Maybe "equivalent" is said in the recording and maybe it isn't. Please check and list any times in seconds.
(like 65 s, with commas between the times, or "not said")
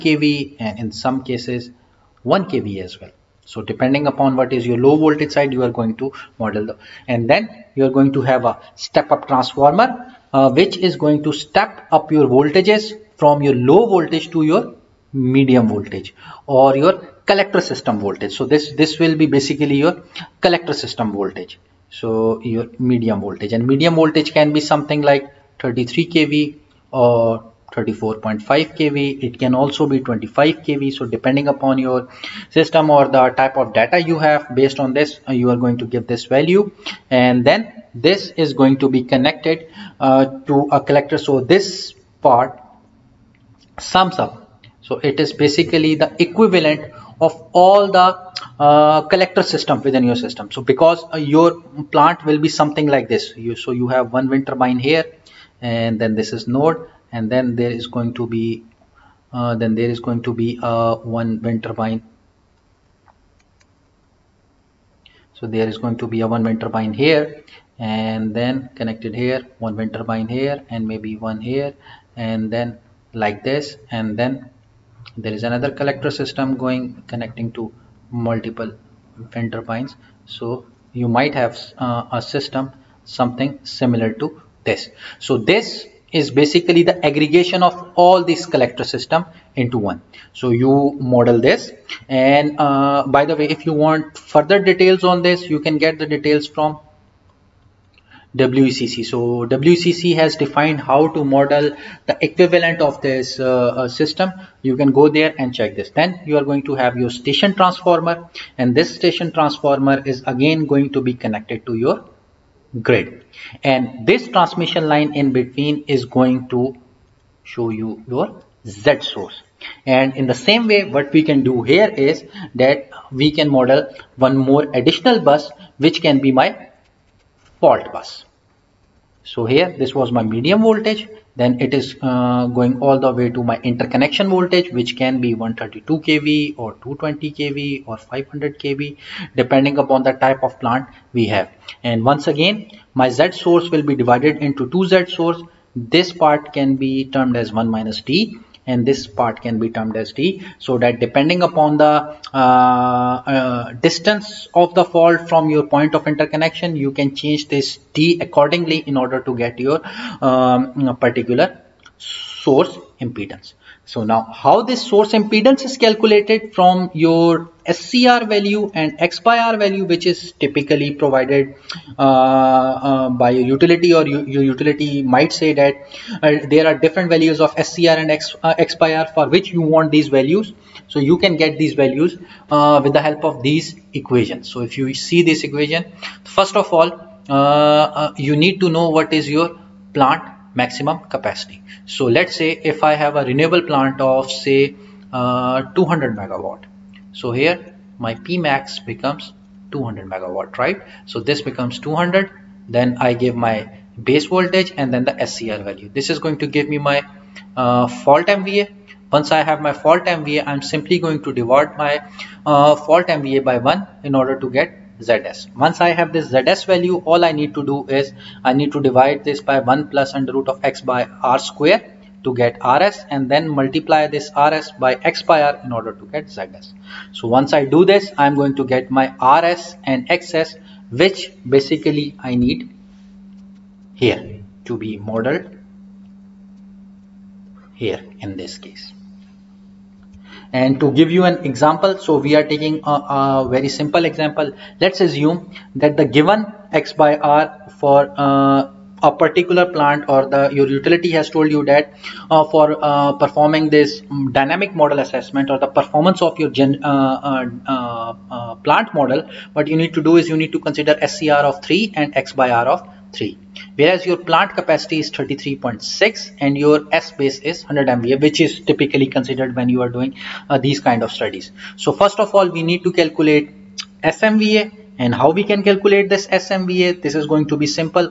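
46 s, 102 s.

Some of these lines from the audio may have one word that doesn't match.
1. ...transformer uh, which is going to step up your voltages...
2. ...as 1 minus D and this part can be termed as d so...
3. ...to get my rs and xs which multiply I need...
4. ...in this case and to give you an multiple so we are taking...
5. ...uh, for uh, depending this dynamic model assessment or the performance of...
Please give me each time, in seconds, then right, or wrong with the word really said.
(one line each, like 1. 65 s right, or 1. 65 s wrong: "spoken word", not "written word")
1. 9 s right
2. 147 s right
3. 228 s wrong: "basically", not "multiply"
4. 238 s wrong: "example", not "multiple"
5. 252 s wrong: "performing", not "depending".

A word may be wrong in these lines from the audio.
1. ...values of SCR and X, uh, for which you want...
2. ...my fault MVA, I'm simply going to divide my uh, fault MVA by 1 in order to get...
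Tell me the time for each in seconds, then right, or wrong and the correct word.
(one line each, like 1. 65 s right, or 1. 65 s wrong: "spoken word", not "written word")
1. 177 s right
2. 209 s right.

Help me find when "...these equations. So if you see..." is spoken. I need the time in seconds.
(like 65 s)
183 s.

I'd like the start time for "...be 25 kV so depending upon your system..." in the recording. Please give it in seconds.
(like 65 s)
29 s.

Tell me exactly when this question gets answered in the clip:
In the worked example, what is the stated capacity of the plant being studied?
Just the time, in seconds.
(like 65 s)
265 s.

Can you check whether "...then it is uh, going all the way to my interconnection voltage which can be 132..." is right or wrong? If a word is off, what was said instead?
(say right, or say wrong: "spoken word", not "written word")
right.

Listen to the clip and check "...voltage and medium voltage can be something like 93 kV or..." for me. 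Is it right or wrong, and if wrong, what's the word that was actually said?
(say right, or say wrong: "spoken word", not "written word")
wrong: "33", not "93".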